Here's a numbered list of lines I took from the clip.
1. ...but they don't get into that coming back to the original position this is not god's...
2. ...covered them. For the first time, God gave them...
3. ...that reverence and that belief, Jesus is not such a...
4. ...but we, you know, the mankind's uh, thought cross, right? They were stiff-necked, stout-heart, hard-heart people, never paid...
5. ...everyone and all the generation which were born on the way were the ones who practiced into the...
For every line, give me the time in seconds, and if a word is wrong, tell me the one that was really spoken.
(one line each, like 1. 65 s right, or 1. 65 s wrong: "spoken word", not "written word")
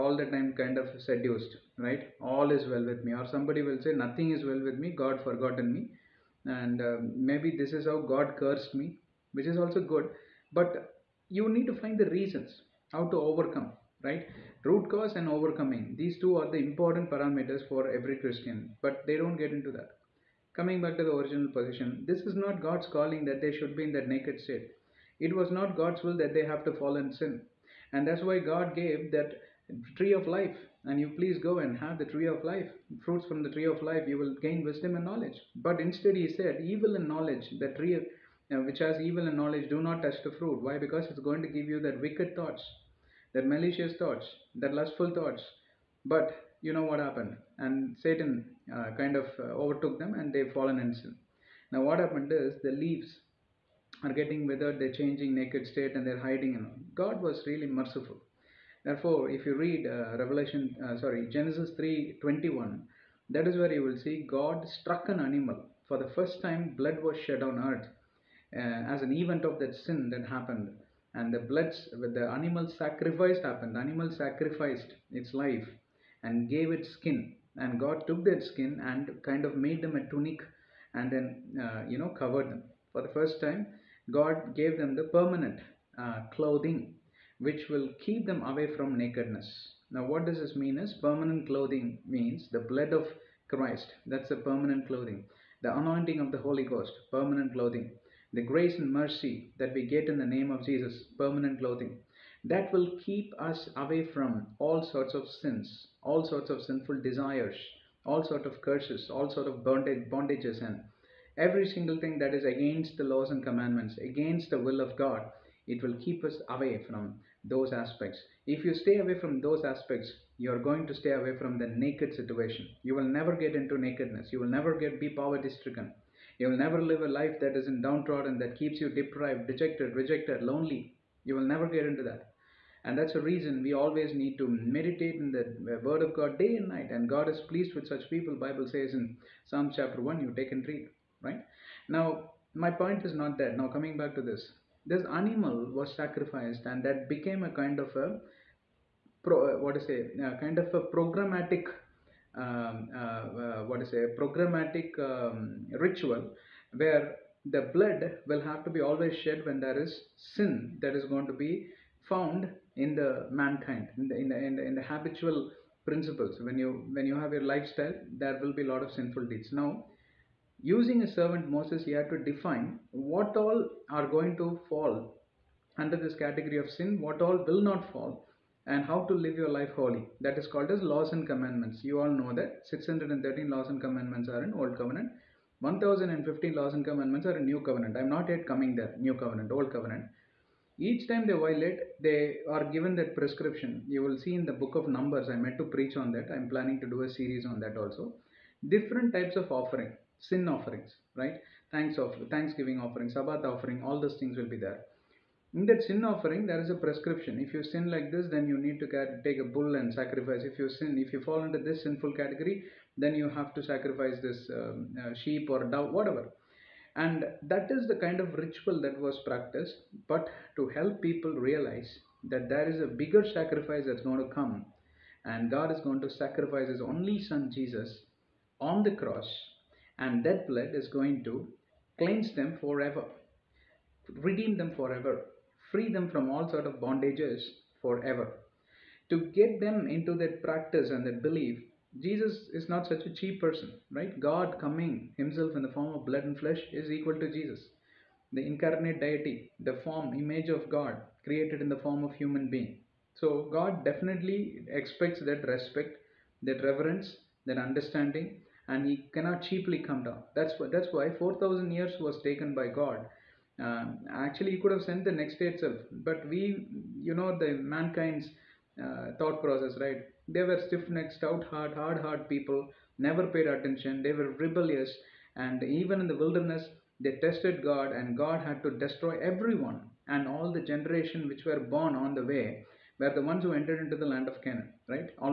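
1. 18 s right
2. 82 s right
3. 240 s wrong: "practice", not "reverence"
4. 266 s wrong: "process", not "cross"
5. 279 s wrong: "entered", not "practiced".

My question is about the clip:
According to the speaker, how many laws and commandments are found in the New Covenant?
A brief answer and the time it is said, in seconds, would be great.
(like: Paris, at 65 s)
1015, at 185 s.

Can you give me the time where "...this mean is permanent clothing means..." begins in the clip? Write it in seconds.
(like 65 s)
90 s.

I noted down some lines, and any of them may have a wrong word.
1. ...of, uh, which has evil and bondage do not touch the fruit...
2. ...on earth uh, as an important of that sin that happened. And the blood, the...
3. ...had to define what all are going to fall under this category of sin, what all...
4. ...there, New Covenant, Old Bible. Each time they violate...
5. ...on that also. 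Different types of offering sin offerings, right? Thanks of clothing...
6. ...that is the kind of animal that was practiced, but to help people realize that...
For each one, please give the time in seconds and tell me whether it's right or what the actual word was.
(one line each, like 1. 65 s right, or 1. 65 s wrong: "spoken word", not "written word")
1. 37 s wrong: "knowledge", not "bondage"
2. 67 s wrong: "event", not "important"
3. 171 s right
4. 188 s wrong: "Covenant", not "Bible"
5. 197 s wrong: "thanksgiving", not "clothing"
6. 217 s wrong: "ritual", not "animal".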